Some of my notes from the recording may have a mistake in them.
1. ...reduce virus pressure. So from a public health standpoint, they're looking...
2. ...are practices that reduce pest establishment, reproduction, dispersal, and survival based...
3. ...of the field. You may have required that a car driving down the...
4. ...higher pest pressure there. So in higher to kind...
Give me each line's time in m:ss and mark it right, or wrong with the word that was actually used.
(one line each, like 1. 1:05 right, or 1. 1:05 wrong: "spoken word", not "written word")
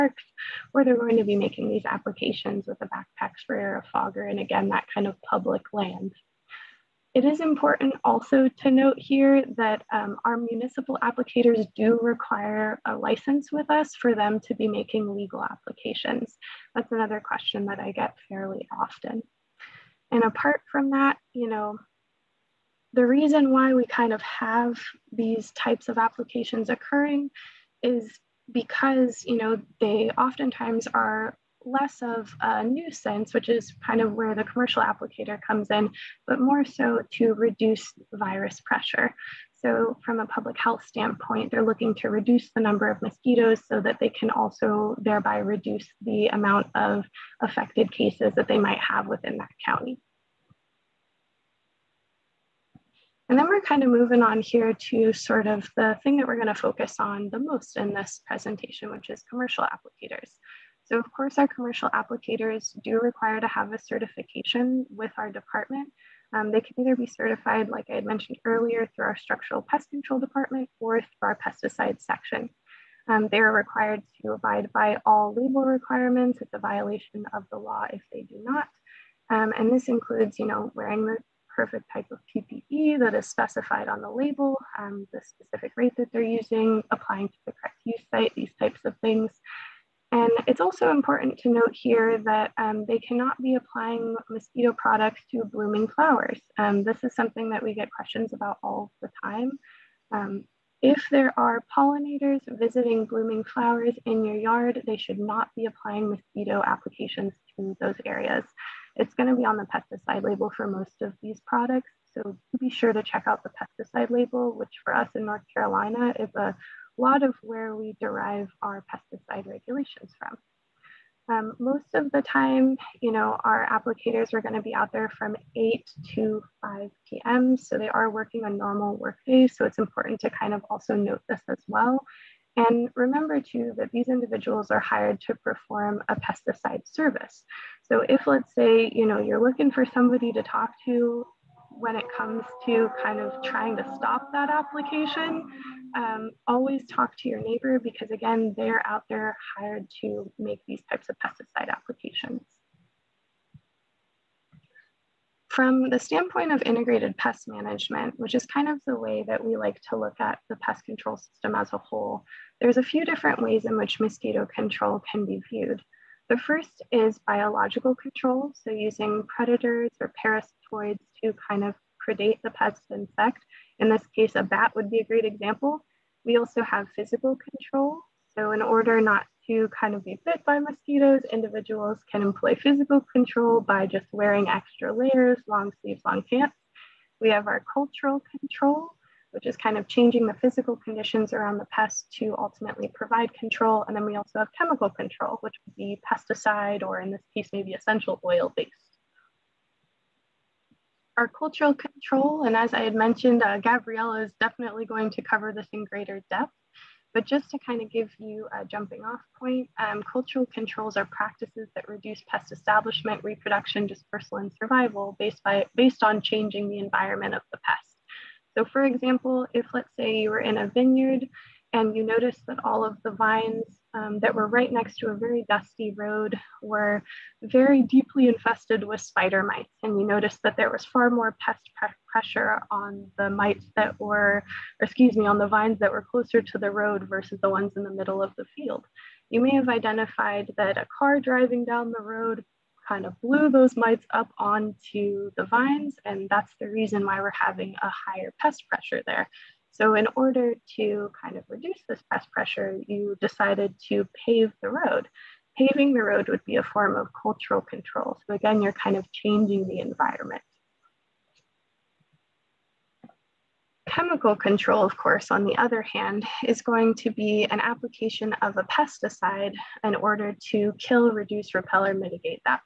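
1. 0:37 right
2. 3:30 right
3. 3:58 wrong: "identified", not "required"
4. 4:07 wrong: "order", not "higher".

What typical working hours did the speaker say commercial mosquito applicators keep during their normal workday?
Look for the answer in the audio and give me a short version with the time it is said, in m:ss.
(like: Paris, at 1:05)
8 to 5 p.m., at 2:05.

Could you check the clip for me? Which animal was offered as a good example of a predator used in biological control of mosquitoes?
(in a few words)
a bat.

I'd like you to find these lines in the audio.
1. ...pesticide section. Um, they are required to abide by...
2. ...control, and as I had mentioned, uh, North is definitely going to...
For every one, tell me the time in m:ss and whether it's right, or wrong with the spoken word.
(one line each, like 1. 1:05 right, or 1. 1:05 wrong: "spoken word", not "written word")
1. 1:11 right
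2. 3:21 wrong: "Gabriela", not "North".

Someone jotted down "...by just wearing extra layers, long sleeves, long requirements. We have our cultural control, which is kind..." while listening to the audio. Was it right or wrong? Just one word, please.
wrong.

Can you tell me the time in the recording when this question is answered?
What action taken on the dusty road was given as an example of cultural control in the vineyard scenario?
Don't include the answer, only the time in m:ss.
4:14.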